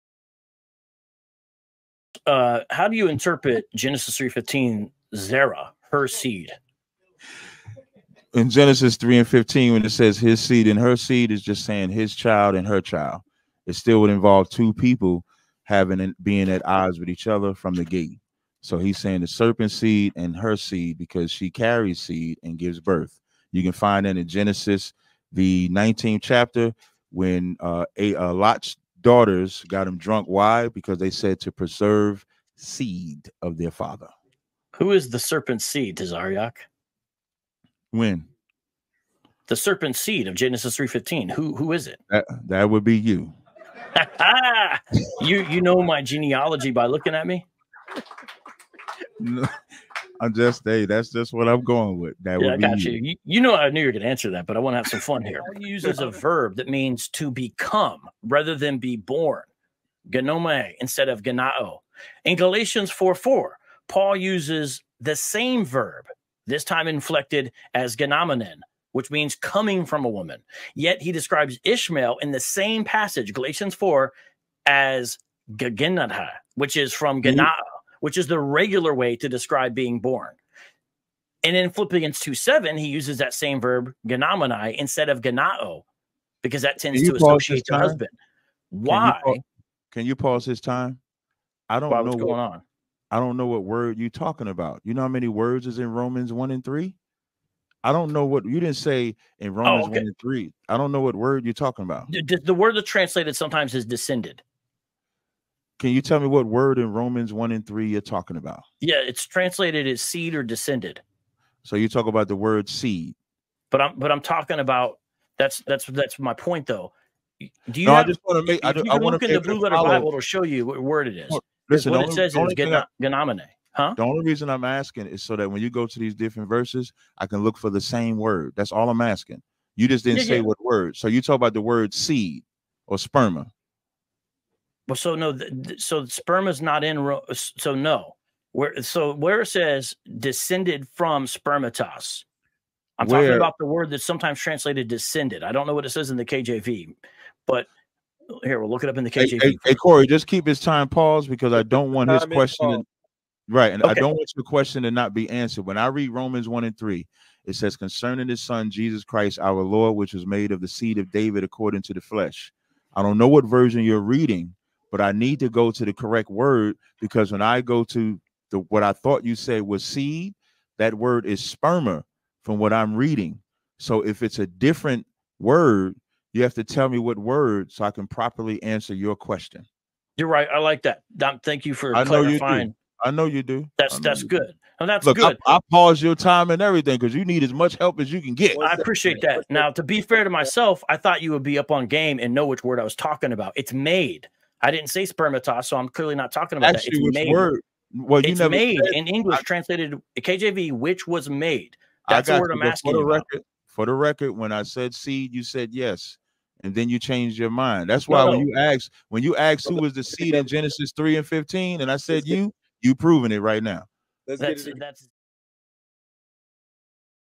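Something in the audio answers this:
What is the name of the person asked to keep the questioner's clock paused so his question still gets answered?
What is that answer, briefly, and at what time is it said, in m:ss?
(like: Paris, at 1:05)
Corey, at 2:29.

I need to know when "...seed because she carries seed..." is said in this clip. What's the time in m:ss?
0:20.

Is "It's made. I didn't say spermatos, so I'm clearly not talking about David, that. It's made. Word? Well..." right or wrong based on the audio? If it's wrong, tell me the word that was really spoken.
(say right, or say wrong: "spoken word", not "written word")
wrong: "Actually", not "David".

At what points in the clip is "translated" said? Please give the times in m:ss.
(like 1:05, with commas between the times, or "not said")
1:42, 1:49, 2:24, 3:19.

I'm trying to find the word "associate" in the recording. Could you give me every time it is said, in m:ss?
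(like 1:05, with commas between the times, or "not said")
1:27.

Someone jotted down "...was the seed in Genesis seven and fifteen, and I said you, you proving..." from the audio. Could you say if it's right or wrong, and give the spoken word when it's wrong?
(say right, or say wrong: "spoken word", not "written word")
wrong: "three", not "seven".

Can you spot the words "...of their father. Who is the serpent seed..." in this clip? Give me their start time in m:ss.
0:33.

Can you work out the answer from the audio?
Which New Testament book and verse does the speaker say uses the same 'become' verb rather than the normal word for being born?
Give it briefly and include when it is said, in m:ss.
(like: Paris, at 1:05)
Philippians 2:7, at 1:21.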